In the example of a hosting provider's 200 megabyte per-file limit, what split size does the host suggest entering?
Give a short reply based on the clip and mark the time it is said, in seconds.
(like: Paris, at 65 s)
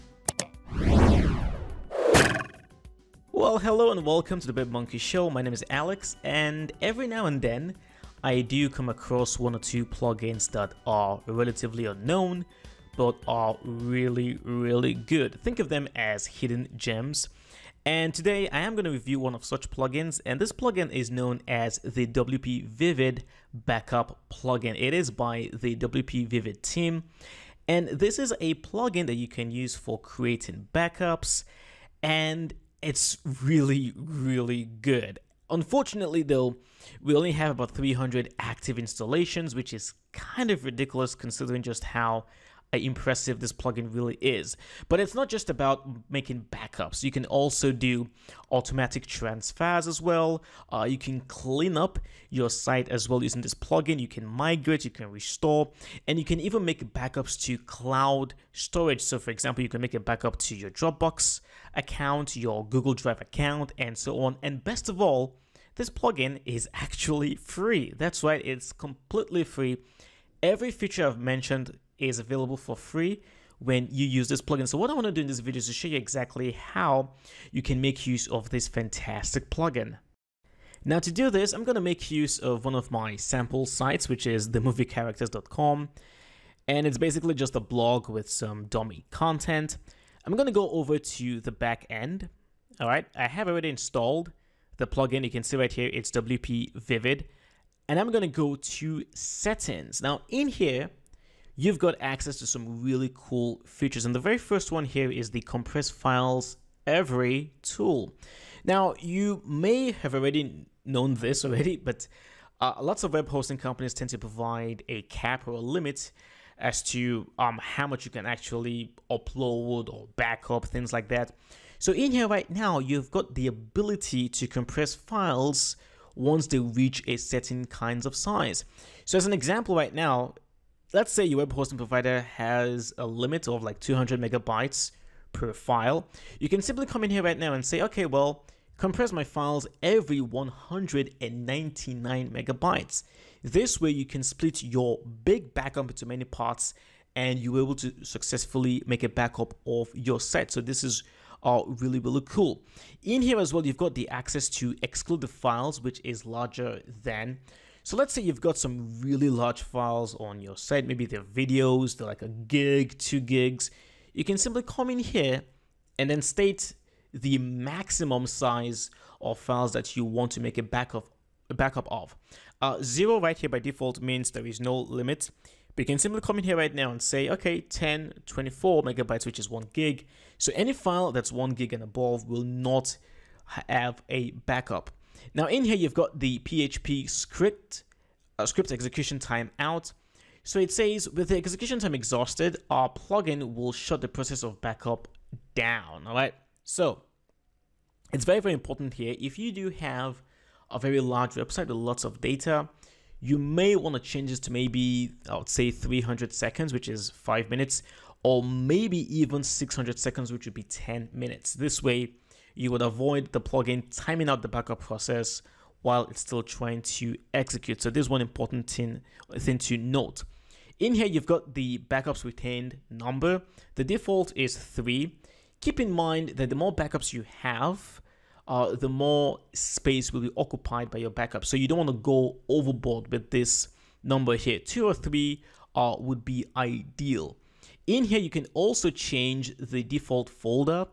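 199 megabytes, at 140 s.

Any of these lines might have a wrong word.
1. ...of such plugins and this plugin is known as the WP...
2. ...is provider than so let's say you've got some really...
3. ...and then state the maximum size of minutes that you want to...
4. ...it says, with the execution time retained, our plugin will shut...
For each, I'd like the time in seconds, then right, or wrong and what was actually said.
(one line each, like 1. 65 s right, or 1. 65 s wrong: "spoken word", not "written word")
1. 19 s right
2. 156 s wrong: "larger", not "provider"
3. 165 s wrong: "files", not "minutes"
4. 190 s wrong: "exhausted", not "retained".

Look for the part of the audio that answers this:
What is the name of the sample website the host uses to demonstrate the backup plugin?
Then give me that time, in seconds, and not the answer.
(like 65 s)
84 s.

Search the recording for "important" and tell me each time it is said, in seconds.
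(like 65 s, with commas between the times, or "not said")
198 s, 218 s.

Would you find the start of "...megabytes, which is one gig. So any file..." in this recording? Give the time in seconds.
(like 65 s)
178 s.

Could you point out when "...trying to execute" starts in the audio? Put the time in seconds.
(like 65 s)
216 s.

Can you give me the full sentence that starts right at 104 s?
And the very first one here is the compress files every tool.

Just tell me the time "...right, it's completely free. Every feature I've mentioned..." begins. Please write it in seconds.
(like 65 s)
68 s.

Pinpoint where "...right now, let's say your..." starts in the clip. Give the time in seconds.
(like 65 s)
129 s.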